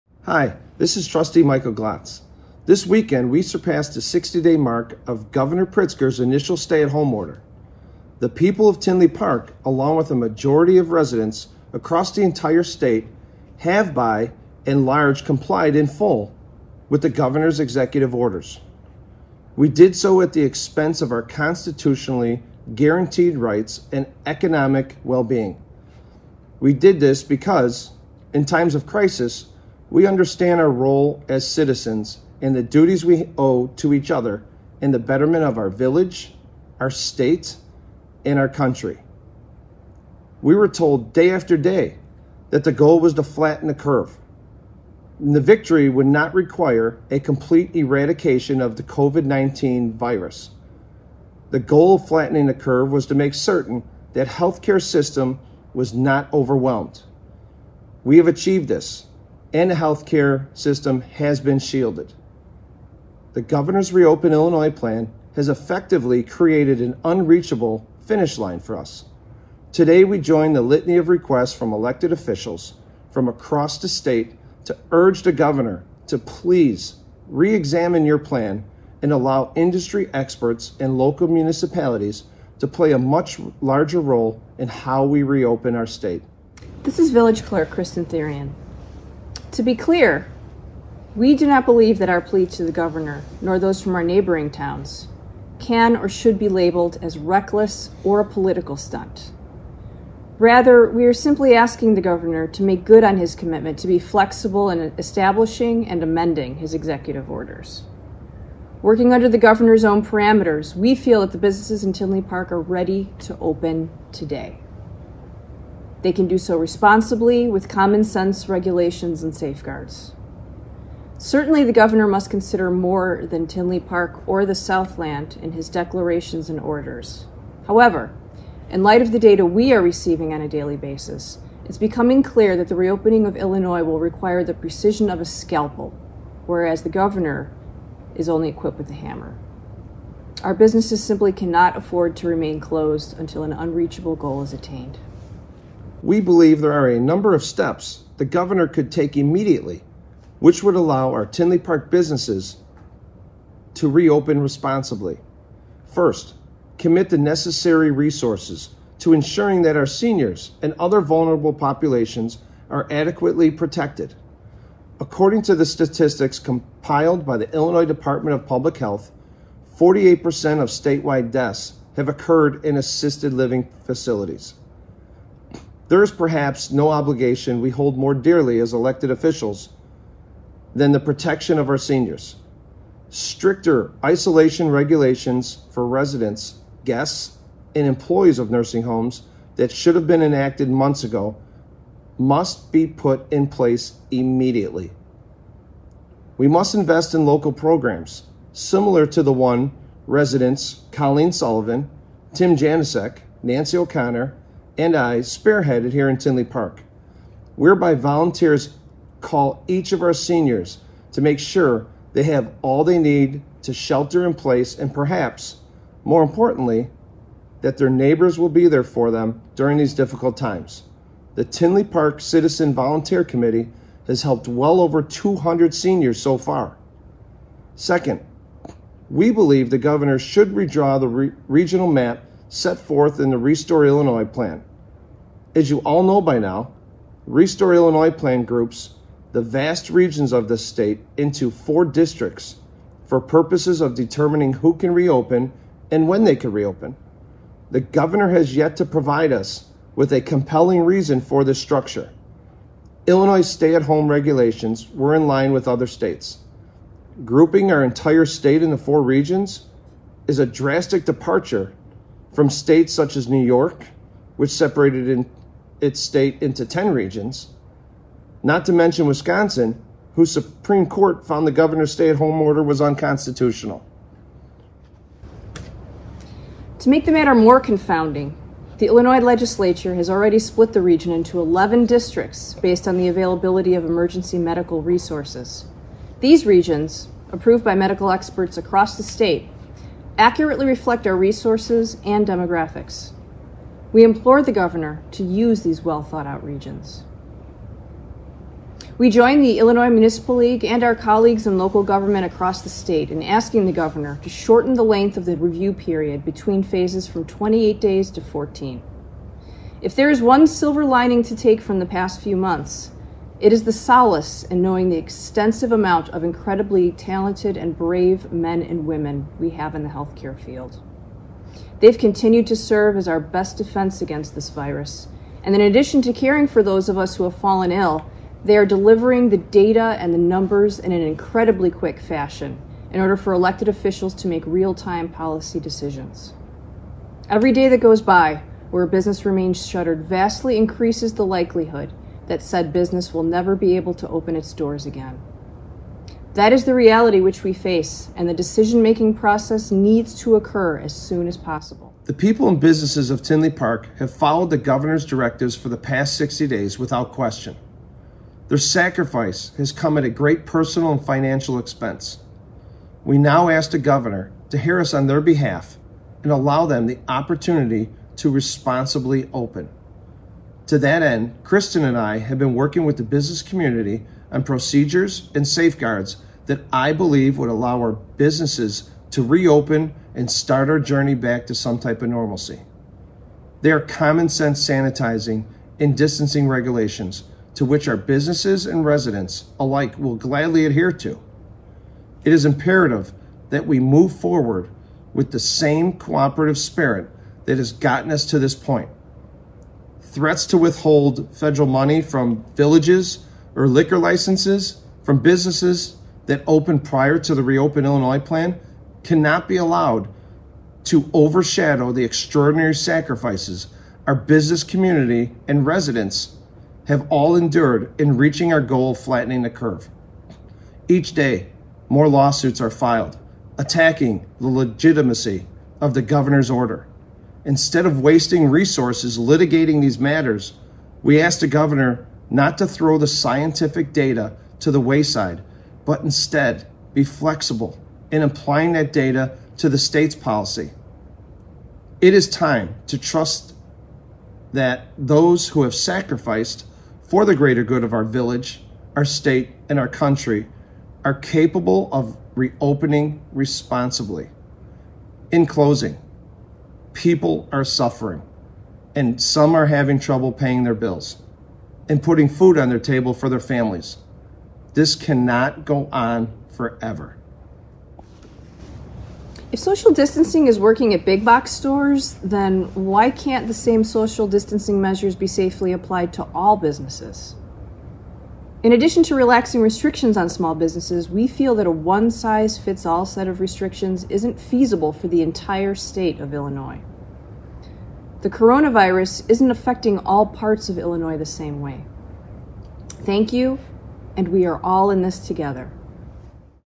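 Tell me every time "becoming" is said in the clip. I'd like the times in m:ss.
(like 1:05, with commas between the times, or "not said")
2:11.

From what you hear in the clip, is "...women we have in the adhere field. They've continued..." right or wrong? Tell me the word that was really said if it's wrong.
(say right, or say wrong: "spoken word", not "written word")
wrong: "healthcare", not "adhere".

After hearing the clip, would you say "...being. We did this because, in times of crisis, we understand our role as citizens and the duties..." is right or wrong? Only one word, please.
right.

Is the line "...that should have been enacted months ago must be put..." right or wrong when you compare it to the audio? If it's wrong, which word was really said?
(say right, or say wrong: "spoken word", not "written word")
right.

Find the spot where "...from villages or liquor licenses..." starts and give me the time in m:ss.
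6:42.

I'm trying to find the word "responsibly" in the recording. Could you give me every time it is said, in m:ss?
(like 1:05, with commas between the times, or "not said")
1:56, 2:34, 6:08, 7:33.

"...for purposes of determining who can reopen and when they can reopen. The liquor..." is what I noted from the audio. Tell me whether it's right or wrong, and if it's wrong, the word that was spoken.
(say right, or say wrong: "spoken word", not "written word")
wrong: "governor", not "liquor".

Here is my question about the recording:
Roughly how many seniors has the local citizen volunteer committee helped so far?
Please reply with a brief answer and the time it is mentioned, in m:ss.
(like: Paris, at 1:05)
Over 200, at 3:44.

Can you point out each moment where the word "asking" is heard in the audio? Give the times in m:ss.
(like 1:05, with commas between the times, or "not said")
1:41, 5:03.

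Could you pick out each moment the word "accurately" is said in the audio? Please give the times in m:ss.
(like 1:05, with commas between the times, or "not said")
4:50.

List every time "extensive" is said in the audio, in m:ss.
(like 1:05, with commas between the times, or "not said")
5:14.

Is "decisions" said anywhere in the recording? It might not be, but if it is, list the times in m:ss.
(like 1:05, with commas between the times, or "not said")
5:35, 5:48.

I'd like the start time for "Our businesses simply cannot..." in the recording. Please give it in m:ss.
2:20.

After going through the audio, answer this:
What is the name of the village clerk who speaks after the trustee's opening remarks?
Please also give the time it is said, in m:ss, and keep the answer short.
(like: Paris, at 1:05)
Kristin Thirion, at 1:27.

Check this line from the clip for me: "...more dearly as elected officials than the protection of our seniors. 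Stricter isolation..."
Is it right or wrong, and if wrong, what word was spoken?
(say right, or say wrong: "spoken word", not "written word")
right.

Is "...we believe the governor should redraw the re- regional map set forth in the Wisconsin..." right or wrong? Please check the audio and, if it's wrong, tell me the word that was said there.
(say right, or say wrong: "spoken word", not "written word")
wrong: "Restore", not "Wisconsin".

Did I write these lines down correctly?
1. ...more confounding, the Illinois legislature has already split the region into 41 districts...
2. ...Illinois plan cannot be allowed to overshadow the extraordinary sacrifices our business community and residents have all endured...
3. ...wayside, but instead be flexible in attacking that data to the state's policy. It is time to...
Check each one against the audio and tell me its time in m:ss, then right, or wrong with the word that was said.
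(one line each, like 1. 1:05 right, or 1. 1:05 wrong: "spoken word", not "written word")
1. 4:37 wrong: "11", not "41"
2. 6:47 right
3. 7:14 wrong: "applying", not "attacking".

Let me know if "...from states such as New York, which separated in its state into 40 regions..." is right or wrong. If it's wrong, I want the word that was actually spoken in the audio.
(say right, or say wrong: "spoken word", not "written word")
wrong: "10", not "40".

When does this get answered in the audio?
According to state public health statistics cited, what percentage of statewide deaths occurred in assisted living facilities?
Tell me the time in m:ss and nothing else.
2:49.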